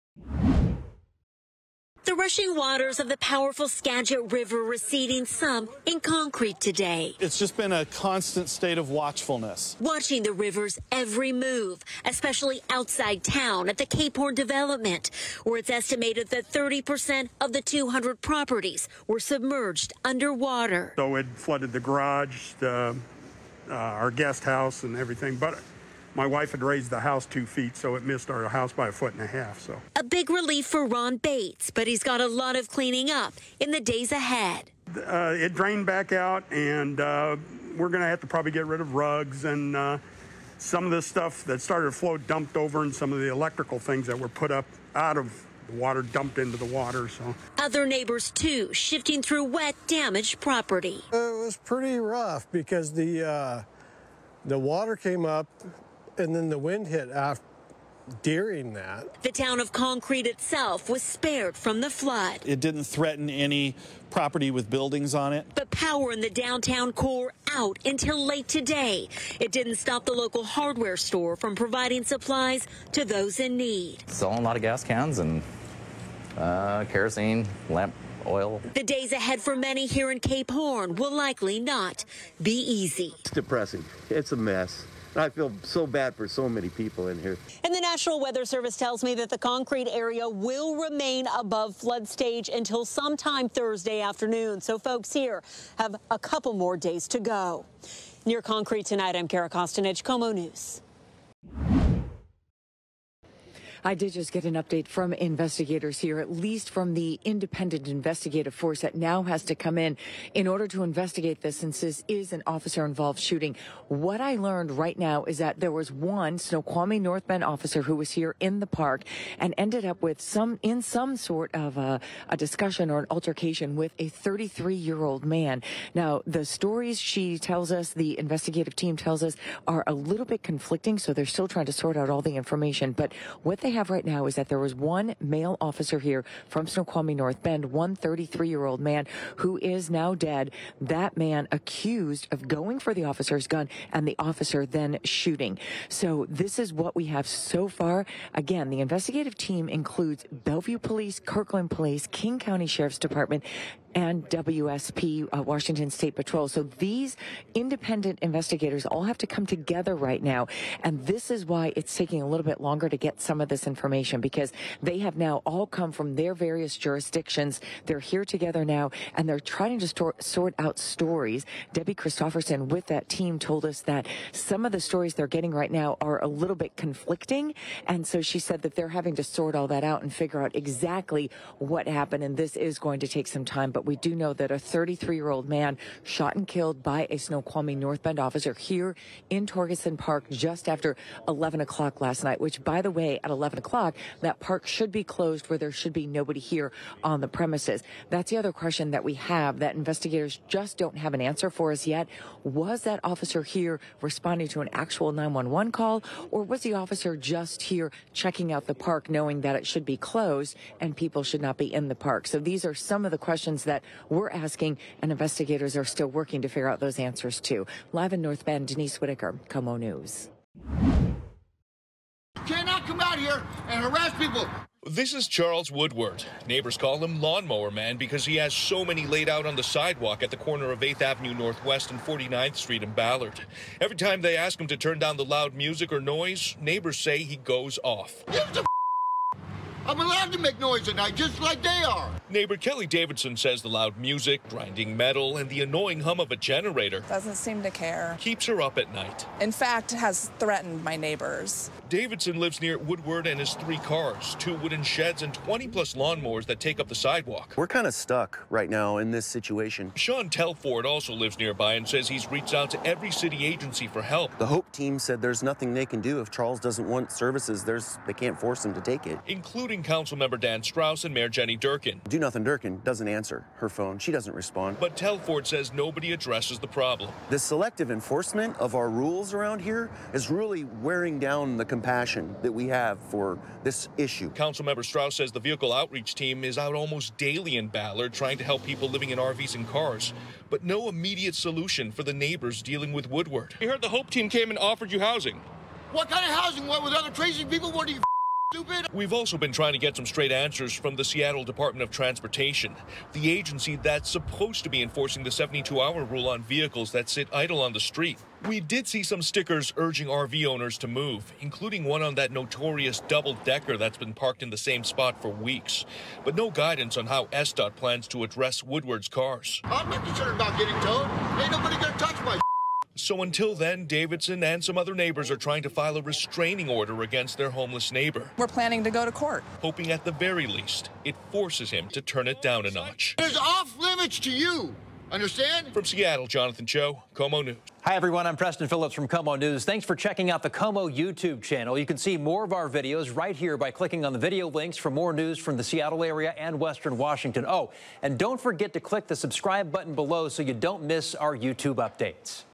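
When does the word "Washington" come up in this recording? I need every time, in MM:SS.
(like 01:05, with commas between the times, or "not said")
02:35, 05:46.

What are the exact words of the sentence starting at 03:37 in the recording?
Live in North Bend, Denise Whitaker, KOMO News.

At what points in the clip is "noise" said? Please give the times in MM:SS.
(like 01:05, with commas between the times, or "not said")
03:56, 04:00.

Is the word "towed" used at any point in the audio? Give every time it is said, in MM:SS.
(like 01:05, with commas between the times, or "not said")
05:20.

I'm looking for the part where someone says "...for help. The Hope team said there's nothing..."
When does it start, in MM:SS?
04:23.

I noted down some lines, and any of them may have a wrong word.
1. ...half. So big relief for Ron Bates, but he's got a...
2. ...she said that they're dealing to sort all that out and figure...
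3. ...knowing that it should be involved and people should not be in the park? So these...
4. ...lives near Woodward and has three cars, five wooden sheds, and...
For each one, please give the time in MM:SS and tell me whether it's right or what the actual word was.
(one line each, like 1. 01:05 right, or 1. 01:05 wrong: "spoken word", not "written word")
1. 00:29 right
2. 02:58 wrong: "having", not "dealing"
3. 03:29 wrong: "closed", not "involved"
4. 04:12 wrong: "two", not "five".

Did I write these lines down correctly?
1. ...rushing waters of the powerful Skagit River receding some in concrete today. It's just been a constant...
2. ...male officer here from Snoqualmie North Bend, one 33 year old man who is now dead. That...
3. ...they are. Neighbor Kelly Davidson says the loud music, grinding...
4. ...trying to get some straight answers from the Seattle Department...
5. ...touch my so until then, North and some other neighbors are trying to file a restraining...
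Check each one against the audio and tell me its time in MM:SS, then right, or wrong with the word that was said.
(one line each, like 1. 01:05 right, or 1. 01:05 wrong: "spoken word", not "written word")
1. 00:02 right
2. 02:15 right
3. 04:01 right
4. 04:59 right
5. 05:21 wrong: "Davidson", not "North".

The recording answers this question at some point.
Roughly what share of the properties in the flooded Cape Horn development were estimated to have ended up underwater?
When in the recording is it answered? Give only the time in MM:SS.
00:16.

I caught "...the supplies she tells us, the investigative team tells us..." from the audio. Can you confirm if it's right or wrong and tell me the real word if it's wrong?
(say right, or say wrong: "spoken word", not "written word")
wrong: "stories", not "supplies".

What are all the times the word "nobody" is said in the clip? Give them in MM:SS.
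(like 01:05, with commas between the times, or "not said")
03:16, 04:35, 05:21.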